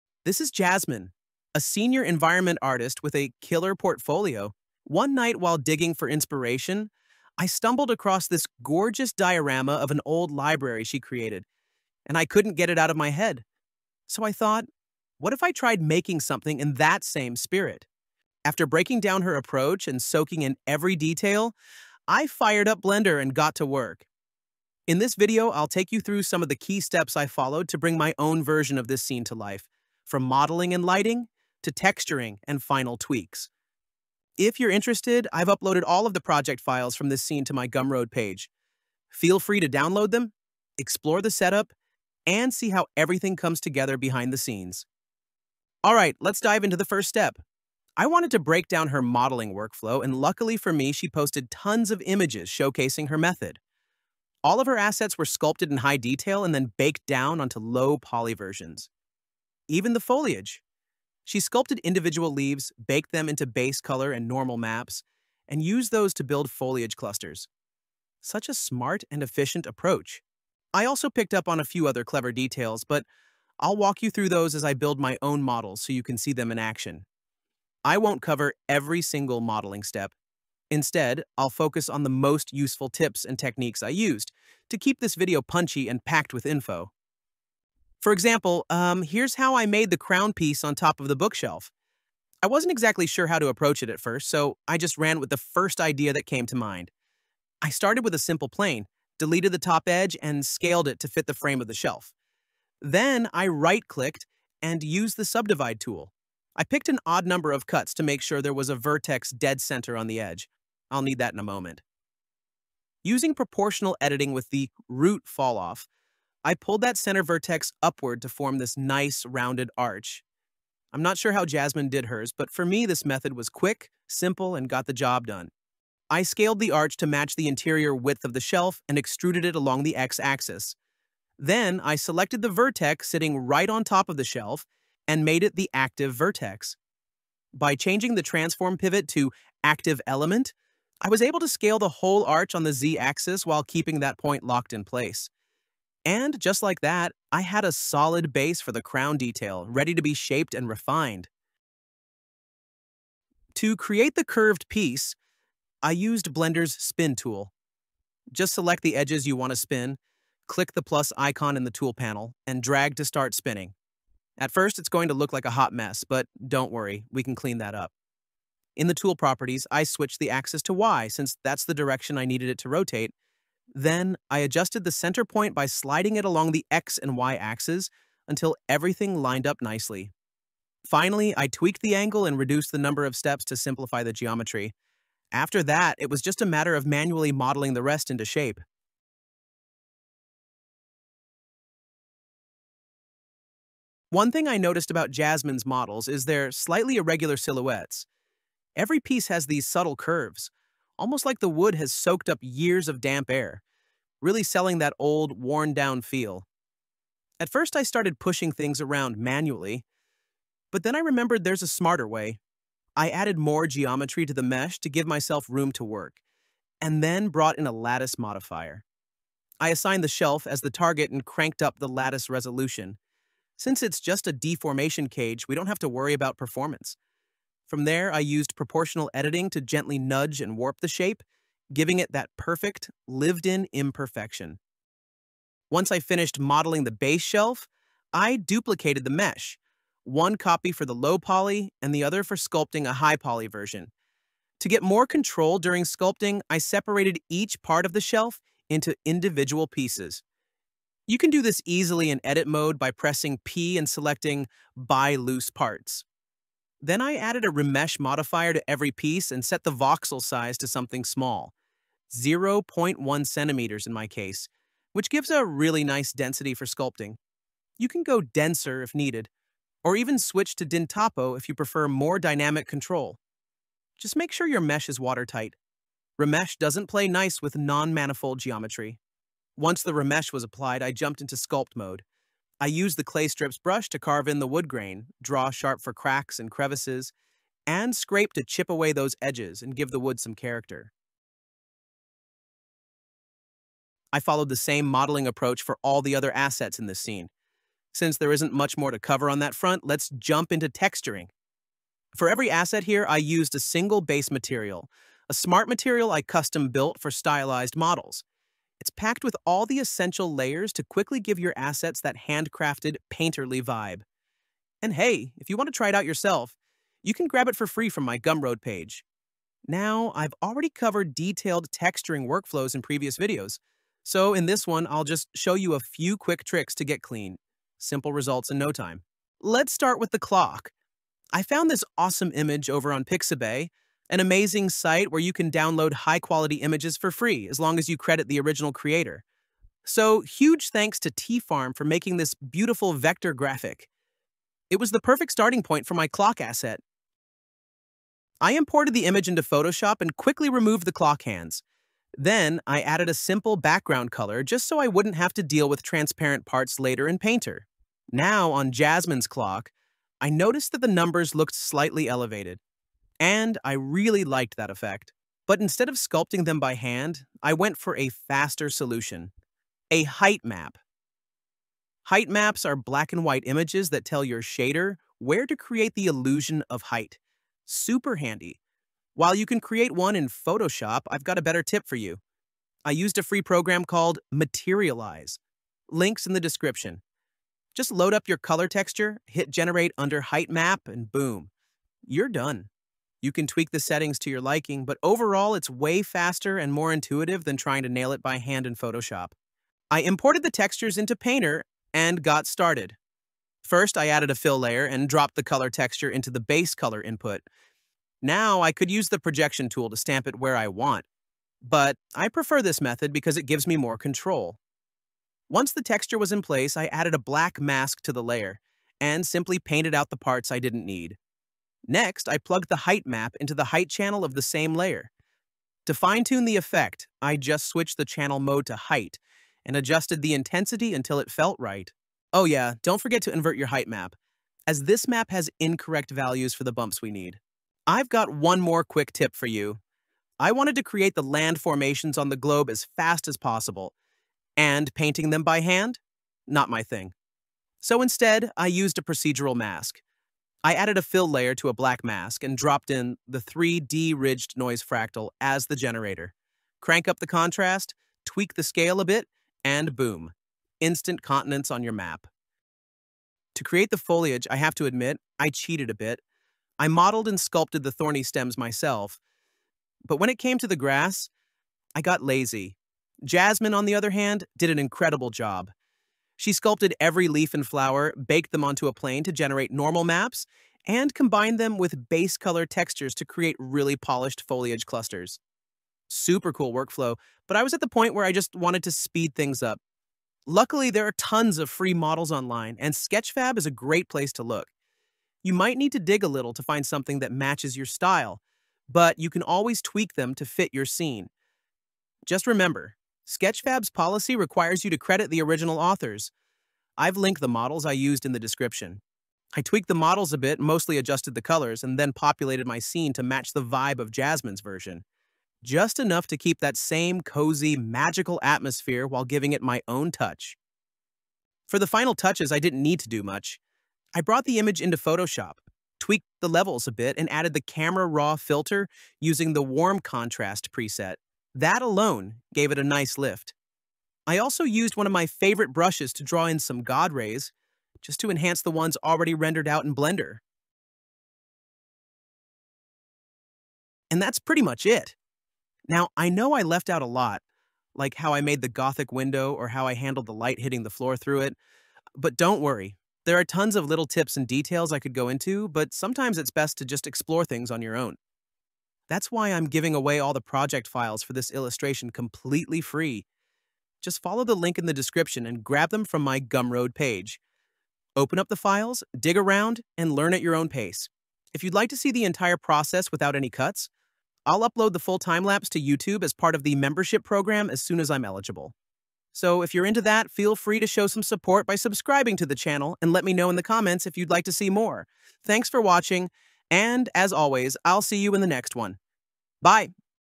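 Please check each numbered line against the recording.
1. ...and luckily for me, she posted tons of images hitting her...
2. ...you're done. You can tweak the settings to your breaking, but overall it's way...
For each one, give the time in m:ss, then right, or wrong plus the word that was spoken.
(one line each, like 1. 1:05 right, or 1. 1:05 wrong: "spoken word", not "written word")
1. 0:50 wrong: "showcasing", not "hitting"
2. 6:32 wrong: "liking", not "breaking".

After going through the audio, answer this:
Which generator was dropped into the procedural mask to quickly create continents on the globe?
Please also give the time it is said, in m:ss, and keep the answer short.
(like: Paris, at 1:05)
3D ridged noise fractal, at 7:33.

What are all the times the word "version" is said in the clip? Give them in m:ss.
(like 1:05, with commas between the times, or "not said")
0:28, 0:58, 4:03, 8:34.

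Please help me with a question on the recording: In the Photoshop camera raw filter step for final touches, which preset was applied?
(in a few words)
Warm contrast.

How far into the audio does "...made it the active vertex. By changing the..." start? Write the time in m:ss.
2:15.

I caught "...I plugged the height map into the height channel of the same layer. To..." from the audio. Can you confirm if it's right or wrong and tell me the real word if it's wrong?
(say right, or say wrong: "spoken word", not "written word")
right.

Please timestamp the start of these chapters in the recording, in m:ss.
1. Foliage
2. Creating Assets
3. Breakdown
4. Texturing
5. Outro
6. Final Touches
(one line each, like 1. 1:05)
1. 7:45
2. 1:10
3. 0:45
4. 4:50
5. 9:03
6. 8:40.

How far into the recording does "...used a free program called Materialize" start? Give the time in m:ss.
6:22.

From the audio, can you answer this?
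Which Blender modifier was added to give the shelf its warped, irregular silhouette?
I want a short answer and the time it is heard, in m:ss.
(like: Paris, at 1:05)
Lattice modifier, at 3:37.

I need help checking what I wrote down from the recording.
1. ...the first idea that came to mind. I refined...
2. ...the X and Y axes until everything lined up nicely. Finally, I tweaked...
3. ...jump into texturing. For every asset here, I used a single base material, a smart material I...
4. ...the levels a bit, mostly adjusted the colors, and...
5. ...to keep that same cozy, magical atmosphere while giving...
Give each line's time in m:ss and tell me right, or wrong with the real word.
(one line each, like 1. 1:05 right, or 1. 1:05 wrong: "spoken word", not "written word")
1. 1:35 wrong: "started", not "refined"
2. 2:56 right
3. 5:00 right
4. 8:29 wrong: "models", not "levels"
5. 8:36 right.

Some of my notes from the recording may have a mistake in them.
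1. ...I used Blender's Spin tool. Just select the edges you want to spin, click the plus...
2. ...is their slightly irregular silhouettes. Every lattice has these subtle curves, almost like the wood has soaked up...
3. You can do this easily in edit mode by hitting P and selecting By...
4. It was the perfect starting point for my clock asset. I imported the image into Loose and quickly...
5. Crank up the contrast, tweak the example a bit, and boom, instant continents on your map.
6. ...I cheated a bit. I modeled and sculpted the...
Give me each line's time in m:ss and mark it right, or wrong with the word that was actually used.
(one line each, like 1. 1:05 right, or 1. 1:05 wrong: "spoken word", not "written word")
1. 2:35 right
2. 3:16 wrong: "piece", not "lattice"
3. 4:11 wrong: "pressing", not "hitting"
4. 5:44 wrong: "Photoshop", not "Loose"
5. 7:36 wrong: "scale", not "example"
6. 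7:45 right.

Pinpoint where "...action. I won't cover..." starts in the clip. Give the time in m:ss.
1:16.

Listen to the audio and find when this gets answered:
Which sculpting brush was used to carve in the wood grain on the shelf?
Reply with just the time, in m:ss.
4:43.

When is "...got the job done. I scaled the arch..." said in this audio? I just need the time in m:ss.
2:04.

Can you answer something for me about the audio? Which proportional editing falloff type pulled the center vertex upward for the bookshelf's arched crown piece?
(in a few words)
Root.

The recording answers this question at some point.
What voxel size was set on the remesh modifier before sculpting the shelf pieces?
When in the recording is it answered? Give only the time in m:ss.
4:22.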